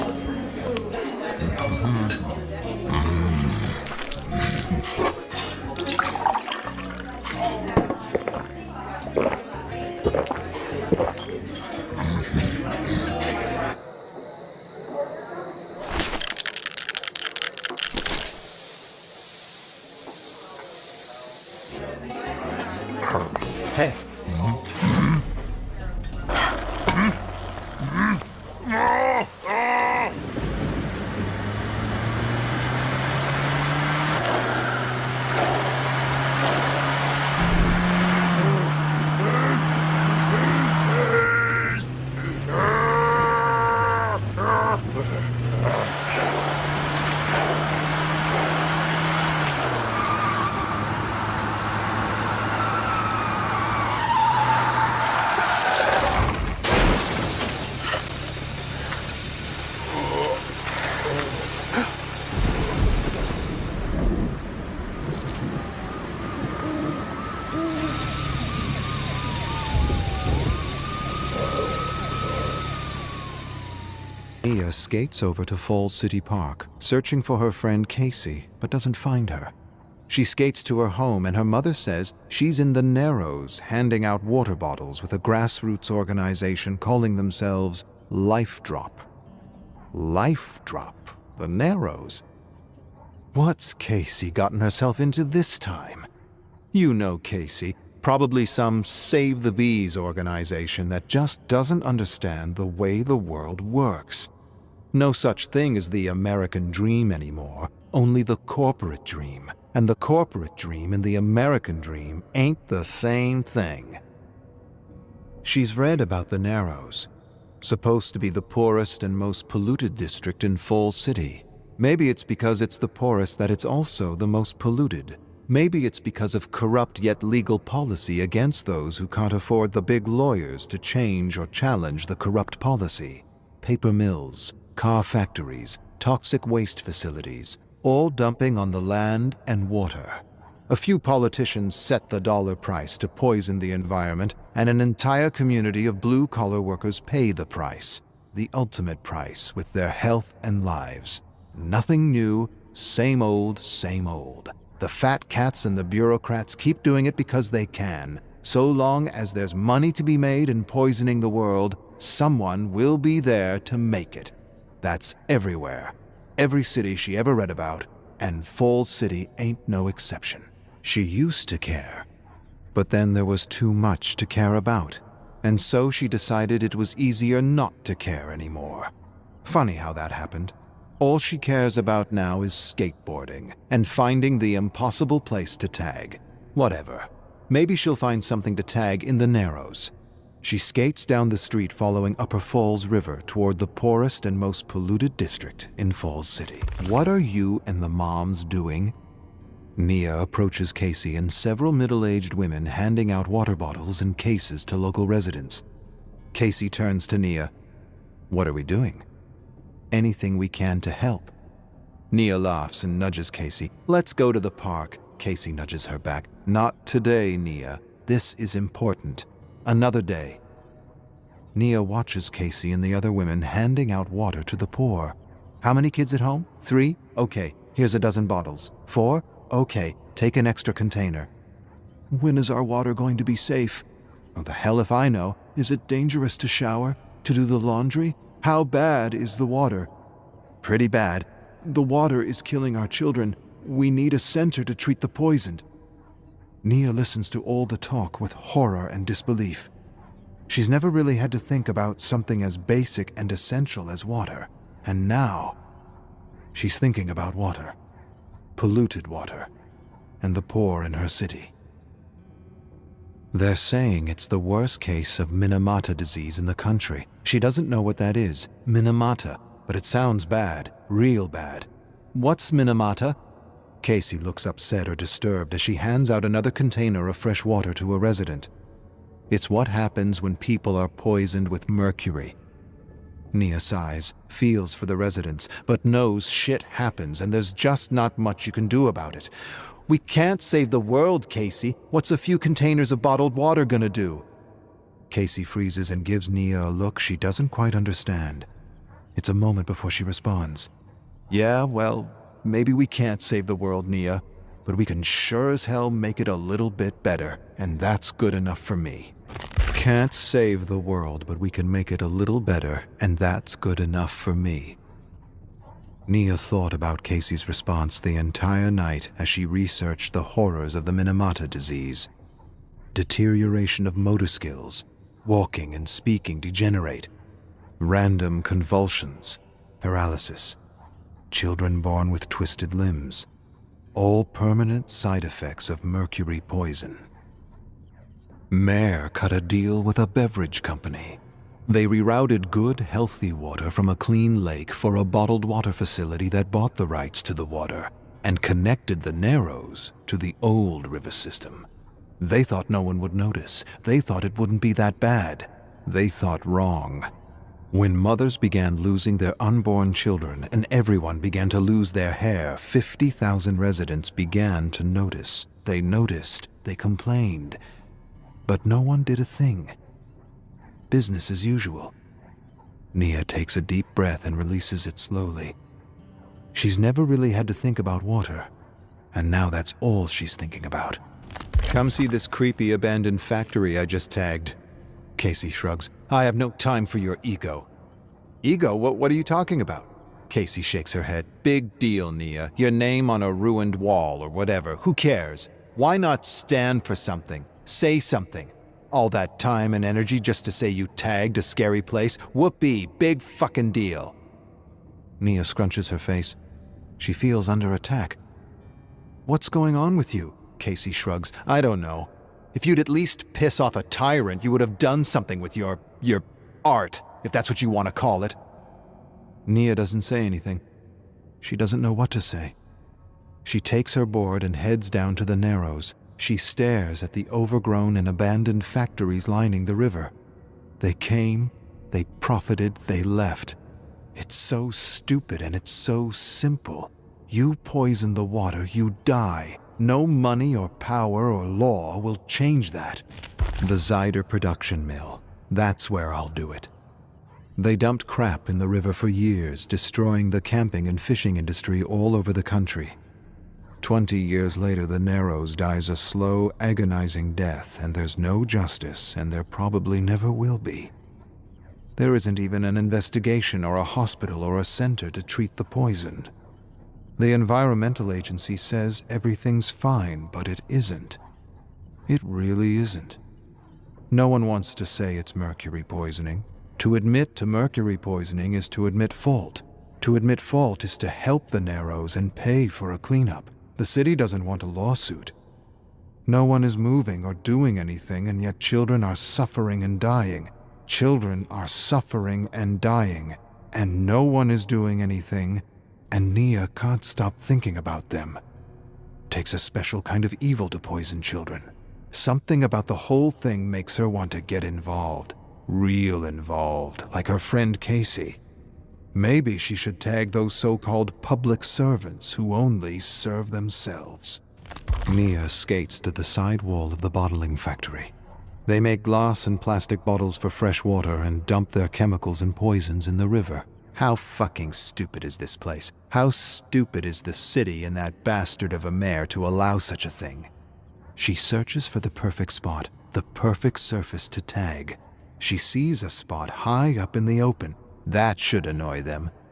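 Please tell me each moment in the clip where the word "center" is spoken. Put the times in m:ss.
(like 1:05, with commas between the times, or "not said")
4:04, 7:44.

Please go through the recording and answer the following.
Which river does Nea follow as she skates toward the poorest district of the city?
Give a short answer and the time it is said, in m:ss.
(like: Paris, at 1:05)
Upper Falls River, at 3:12.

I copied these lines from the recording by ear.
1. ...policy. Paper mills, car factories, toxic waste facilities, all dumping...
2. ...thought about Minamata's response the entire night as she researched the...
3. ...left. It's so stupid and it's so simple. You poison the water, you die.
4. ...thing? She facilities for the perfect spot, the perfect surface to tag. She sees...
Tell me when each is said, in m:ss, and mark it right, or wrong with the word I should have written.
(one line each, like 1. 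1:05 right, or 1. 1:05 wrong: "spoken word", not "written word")
1. 2:12 right
2. 5:16 wrong: "Casey", not "Minamata"
3. 7:13 right
4. 8:50 wrong: "searches", not "facilities".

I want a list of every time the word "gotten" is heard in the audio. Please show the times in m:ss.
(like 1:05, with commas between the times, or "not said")
1:34.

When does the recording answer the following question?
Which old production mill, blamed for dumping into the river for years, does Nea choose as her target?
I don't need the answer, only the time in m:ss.
7:23.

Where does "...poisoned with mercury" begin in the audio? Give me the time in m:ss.
4:40.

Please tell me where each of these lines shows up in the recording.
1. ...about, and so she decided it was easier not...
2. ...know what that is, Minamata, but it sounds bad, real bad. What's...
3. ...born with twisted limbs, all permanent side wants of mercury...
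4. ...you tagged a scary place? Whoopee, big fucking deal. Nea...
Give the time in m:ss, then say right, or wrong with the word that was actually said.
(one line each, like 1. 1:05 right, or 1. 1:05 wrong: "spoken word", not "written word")
1. 2:54 right
2. 4:27 right
3. 5:31 wrong: "effects", not "wants"
4. 6:40 right.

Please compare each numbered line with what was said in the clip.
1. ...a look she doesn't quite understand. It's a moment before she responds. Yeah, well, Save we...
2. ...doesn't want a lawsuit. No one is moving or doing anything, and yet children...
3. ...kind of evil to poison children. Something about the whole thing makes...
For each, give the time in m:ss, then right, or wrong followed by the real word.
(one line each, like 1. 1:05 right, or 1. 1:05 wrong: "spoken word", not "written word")
1. 4:56 wrong: "Maybe", not "Save"
2. 8:04 right
3. 8:20 right.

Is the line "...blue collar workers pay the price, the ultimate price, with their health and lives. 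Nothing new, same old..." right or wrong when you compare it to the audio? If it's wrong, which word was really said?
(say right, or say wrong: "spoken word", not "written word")
right.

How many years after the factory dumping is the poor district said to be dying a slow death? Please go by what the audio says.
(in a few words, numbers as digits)
20.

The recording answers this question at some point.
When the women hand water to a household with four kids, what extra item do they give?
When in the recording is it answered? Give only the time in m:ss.
3:50.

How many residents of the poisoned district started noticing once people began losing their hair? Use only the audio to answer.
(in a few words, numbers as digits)
50,000.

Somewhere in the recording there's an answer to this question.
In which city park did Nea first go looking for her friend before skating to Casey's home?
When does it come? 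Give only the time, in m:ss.
1:15.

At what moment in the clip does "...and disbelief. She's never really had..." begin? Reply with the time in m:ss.
4:08.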